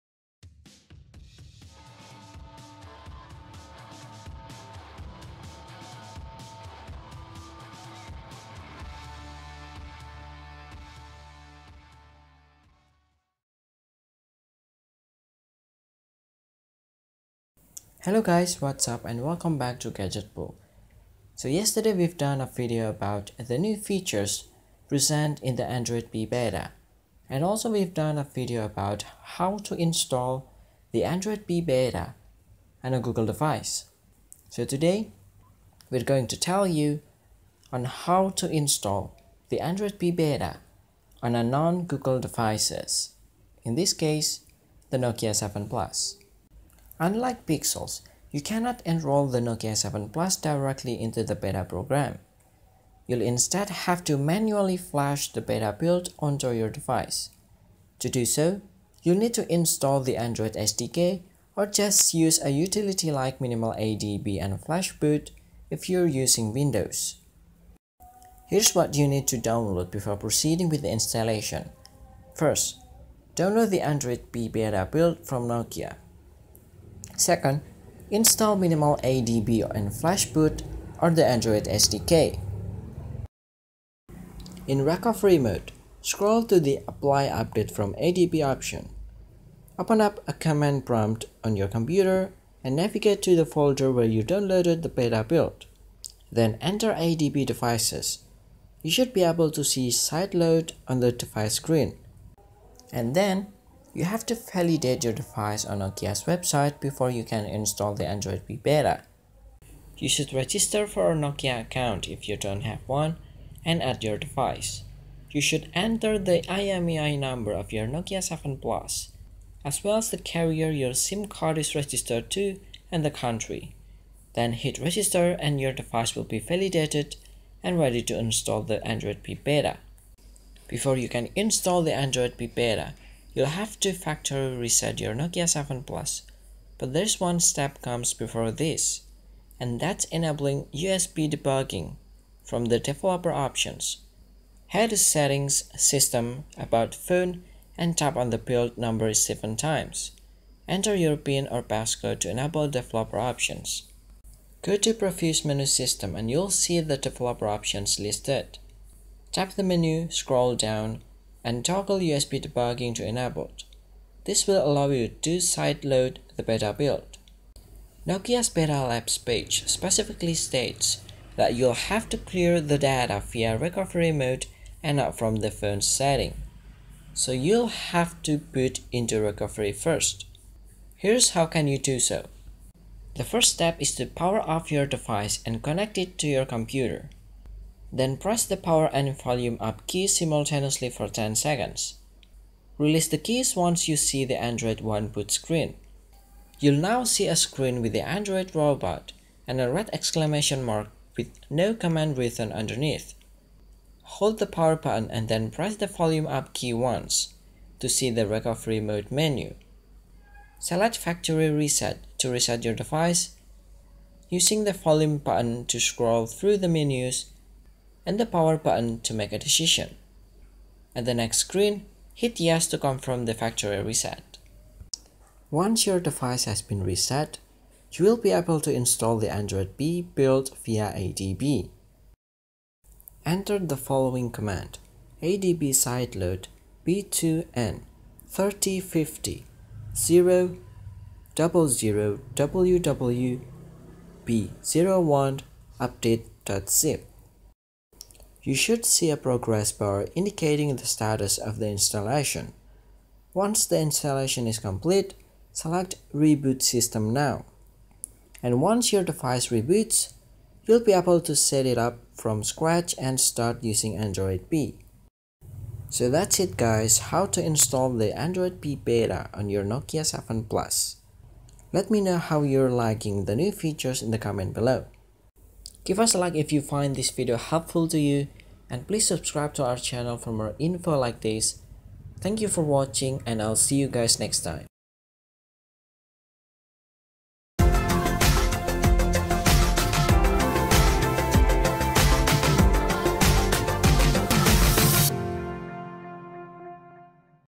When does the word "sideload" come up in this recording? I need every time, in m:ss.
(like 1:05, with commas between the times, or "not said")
1:39, 2:45, 3:55.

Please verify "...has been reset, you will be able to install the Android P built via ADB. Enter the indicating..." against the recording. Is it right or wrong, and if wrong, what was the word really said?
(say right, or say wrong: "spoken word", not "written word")
wrong: "following", not "indicating".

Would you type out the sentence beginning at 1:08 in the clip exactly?
Here's what you need to download before proceeding with the installation.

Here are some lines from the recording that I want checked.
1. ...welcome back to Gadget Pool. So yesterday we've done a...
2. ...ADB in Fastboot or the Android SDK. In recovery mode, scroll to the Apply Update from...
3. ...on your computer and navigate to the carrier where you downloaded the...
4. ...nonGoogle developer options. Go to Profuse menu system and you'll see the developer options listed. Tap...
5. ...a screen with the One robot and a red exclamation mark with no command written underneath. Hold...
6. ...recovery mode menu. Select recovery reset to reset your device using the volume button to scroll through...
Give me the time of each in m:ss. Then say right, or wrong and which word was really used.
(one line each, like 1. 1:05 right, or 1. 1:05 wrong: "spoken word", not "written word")
1. 0:19 right
2. 1:19 right
3. 1:31 wrong: "folder", not "carrier"
4. 2:32 wrong: "enable", not "nonGoogle"
5. 3:17 wrong: "Android", not "One"
6. 3:28 wrong: "factory", not "recovery".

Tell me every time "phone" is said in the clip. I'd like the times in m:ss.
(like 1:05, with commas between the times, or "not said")
2:26, 2:55.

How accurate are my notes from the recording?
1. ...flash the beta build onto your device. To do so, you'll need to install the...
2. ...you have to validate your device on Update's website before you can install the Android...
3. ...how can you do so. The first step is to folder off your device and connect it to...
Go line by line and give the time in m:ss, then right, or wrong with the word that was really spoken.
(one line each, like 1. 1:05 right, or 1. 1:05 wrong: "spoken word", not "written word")
1. 0:54 right
2. 1:43 wrong: "Nokia", not "Update"
3. 3:01 wrong: "power", not "folder".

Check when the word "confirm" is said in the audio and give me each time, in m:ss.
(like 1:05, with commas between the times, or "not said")
3:42.